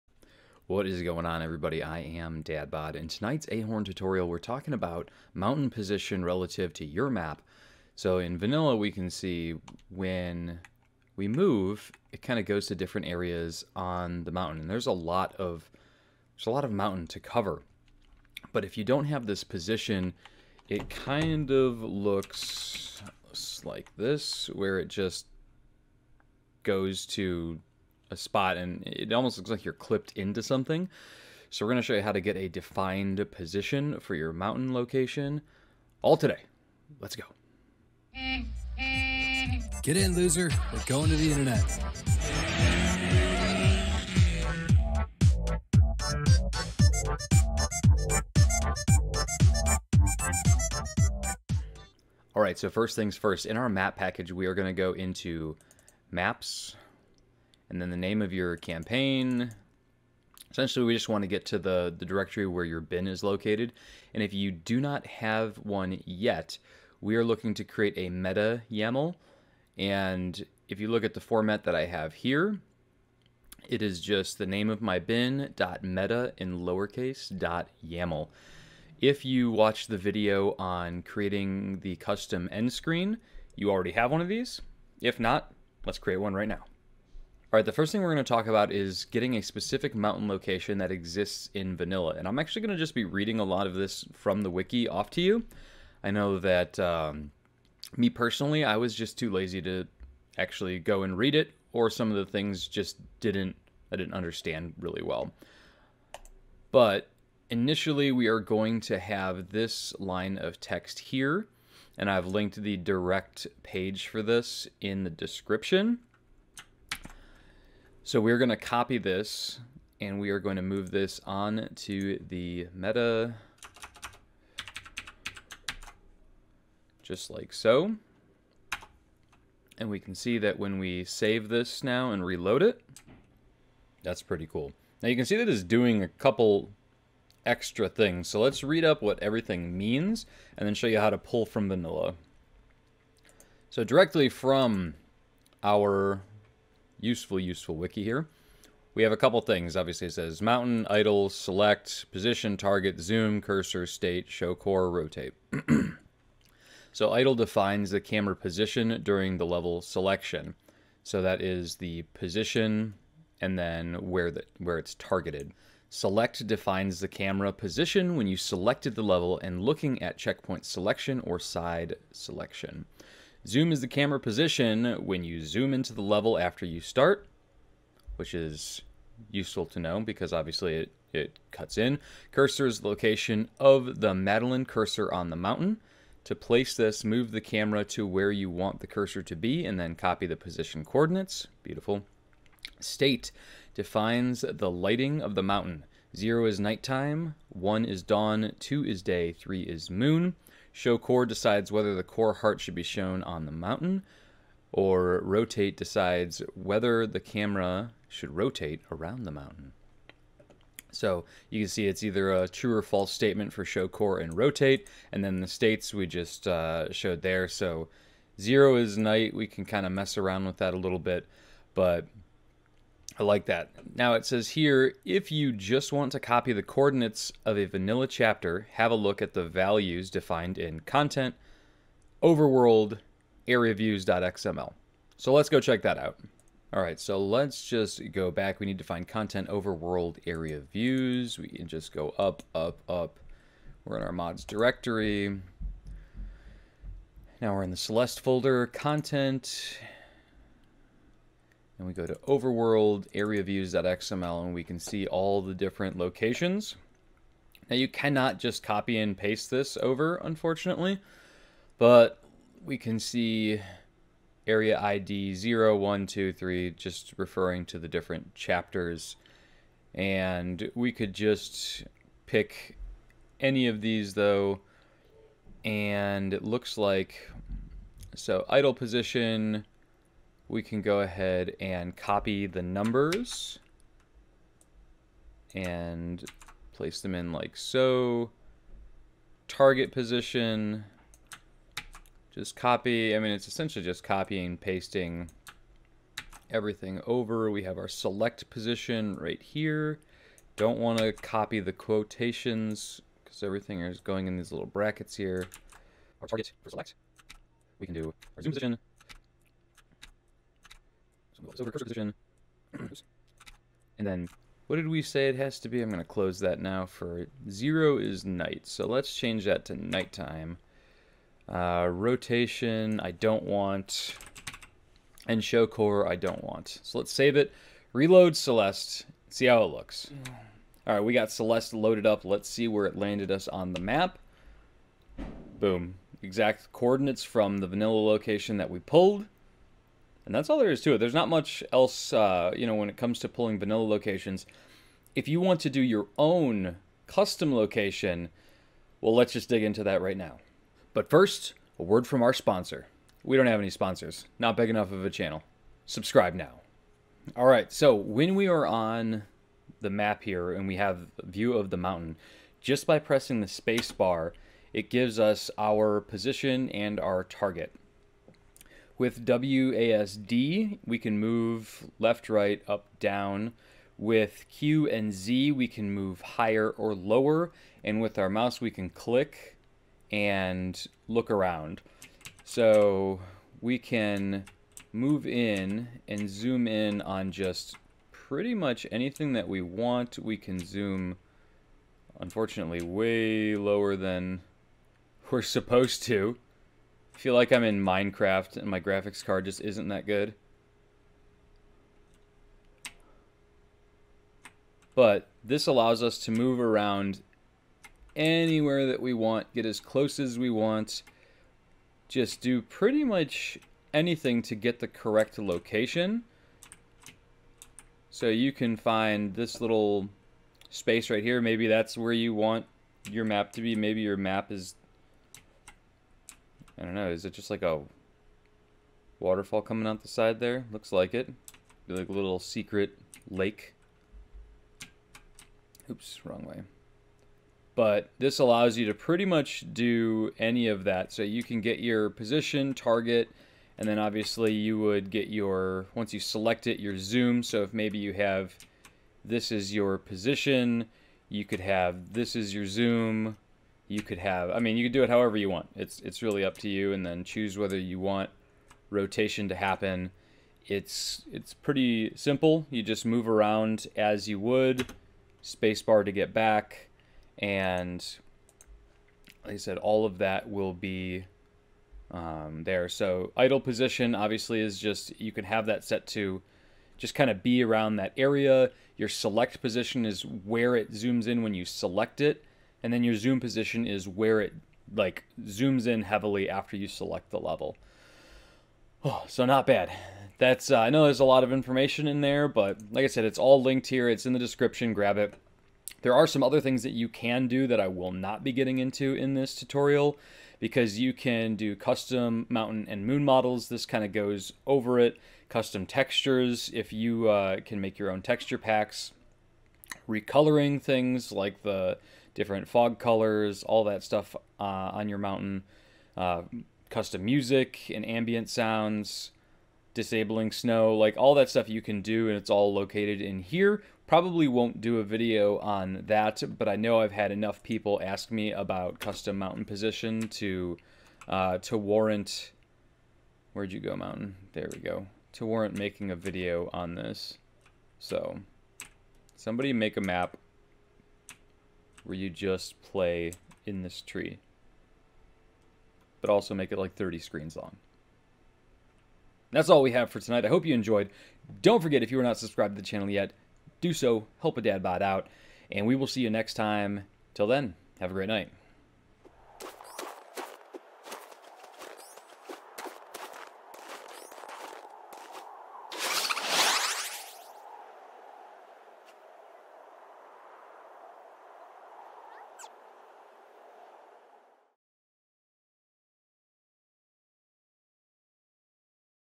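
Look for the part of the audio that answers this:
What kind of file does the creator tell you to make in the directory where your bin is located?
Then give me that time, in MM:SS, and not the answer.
01:08.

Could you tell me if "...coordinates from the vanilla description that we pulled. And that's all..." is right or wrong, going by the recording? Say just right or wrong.
wrong.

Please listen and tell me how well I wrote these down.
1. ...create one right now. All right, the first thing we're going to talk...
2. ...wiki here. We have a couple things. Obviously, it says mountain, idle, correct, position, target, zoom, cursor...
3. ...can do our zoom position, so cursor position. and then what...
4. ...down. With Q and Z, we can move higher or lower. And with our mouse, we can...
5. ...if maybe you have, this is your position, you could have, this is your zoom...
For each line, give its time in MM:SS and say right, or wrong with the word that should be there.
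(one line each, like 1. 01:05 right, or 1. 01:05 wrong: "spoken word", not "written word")
1. 01:25 right
2. 02:27 wrong: "select", not "correct"
3. 05:07 right
4. 06:12 right
5. 07:27 right.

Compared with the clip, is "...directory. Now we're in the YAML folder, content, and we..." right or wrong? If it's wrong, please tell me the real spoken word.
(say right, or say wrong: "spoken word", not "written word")
wrong: "Celeste", not "YAML".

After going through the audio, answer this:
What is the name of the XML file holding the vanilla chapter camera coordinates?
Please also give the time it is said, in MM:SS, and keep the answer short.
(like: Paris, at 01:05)
areaviews.xml, at 03:53.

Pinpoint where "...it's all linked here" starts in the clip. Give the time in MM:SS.
08:13.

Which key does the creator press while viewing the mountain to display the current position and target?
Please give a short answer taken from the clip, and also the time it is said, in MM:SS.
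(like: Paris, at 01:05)
space bar, at 06:03.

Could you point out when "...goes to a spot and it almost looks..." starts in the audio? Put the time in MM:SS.
00:26.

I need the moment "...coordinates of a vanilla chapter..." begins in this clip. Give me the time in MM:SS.
03:46.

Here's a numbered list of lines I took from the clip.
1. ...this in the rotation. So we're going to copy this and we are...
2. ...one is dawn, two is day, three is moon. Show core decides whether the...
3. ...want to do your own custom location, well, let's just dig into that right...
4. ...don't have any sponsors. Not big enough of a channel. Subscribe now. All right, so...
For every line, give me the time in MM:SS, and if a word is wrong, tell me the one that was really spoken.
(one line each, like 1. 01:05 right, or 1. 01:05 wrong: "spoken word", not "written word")
1. 01:54 wrong: "description", not "rotation"
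2. 03:17 right
3. 05:45 right
4. 05:53 right.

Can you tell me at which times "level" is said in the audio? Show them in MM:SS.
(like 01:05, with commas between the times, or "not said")
02:39, 02:49, 02:56, 08:07.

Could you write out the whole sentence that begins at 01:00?
Essentially, we just want to get to the, the directory where your bin is located.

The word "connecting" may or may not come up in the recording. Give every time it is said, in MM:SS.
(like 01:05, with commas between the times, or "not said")
not said.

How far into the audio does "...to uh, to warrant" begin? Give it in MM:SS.
08:50.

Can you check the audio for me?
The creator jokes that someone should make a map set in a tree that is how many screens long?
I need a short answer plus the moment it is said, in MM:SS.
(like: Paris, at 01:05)
30, at 09:06.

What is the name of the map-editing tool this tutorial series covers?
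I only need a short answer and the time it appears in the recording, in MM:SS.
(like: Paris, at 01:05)
Ahorn, at 00:03.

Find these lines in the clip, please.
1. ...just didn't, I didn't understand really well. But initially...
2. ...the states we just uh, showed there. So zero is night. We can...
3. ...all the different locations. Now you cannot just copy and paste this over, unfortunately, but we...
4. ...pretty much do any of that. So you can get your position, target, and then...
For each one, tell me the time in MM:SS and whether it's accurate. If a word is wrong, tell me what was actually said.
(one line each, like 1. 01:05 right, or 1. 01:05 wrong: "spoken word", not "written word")
1. 01:42 right
2. 03:35 right
3. 04:15 right
4. 07:18 right.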